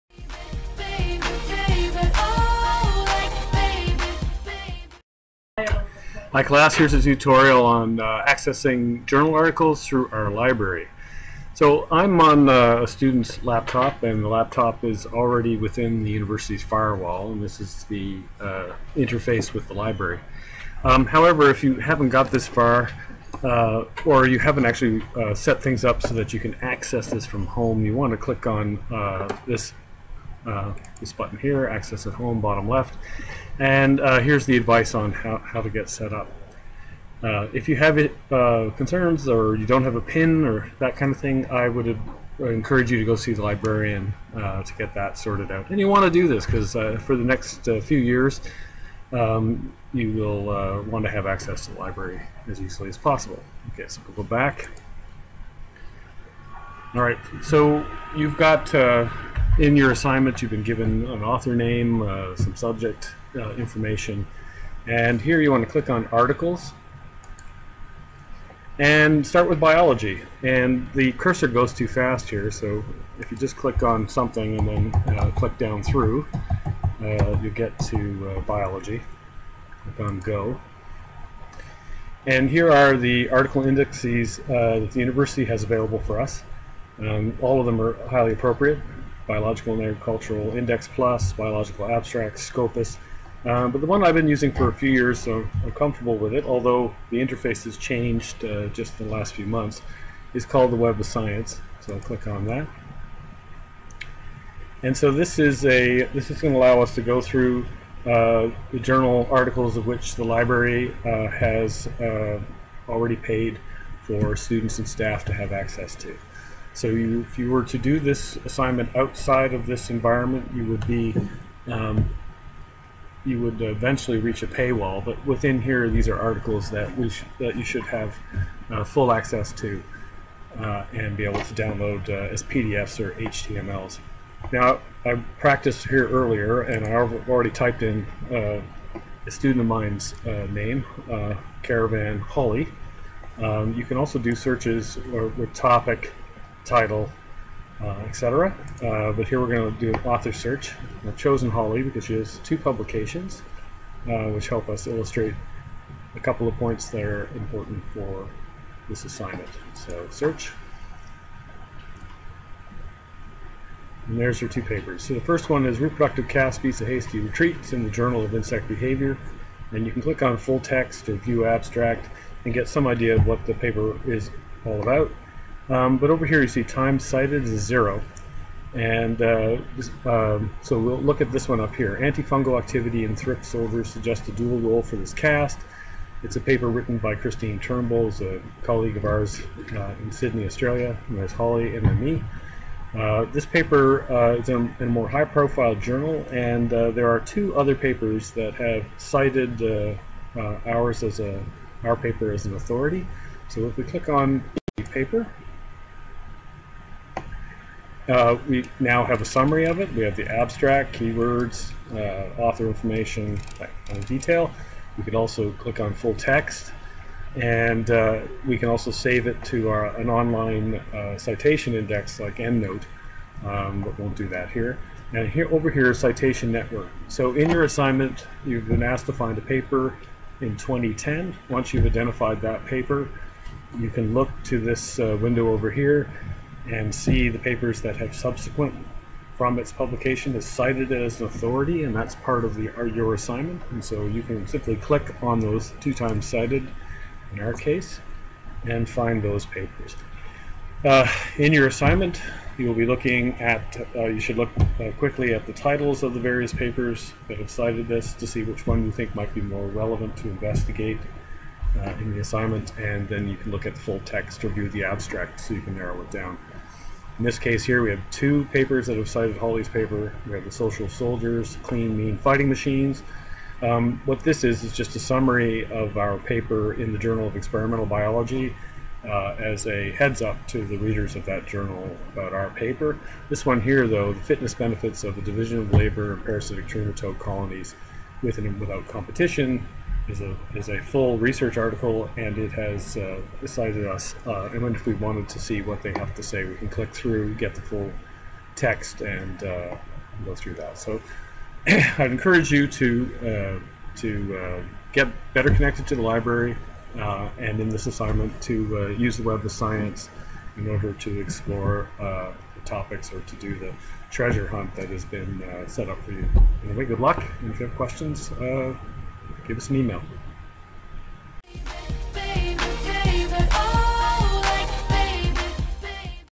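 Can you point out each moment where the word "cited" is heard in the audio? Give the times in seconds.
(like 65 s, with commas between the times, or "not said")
176 s, 198 s, 240 s, 246 s, 257 s, 269 s, 293 s.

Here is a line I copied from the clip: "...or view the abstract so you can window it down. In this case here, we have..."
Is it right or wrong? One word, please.
wrong.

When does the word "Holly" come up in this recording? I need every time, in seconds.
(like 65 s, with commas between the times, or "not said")
142 s, 151 s, 191 s, 269 s.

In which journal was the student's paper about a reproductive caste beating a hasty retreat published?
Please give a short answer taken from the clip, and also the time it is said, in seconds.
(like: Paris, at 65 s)
Journal of Insect Behavior, at 167 s.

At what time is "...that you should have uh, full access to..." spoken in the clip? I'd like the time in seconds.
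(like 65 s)
127 s.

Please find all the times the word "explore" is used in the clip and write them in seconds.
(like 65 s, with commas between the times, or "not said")
311 s.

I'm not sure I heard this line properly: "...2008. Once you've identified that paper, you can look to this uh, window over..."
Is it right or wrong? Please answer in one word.
wrong.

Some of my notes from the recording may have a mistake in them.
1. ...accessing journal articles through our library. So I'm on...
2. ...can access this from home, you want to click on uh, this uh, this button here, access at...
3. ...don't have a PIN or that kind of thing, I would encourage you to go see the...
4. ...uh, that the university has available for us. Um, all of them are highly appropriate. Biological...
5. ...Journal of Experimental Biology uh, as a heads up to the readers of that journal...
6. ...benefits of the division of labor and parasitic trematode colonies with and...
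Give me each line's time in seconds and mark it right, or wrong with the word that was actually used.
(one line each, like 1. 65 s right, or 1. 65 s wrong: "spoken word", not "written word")
1. 8 s right
2. 26 s right
3. 39 s right
4. 84 s right
5. 276 s right
6. 284 s right.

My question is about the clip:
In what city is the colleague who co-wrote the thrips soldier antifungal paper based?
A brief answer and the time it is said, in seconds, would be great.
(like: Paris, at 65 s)
Sydney, at 190 s.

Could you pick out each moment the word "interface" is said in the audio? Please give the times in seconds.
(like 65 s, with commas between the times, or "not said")
18 s, 97 s.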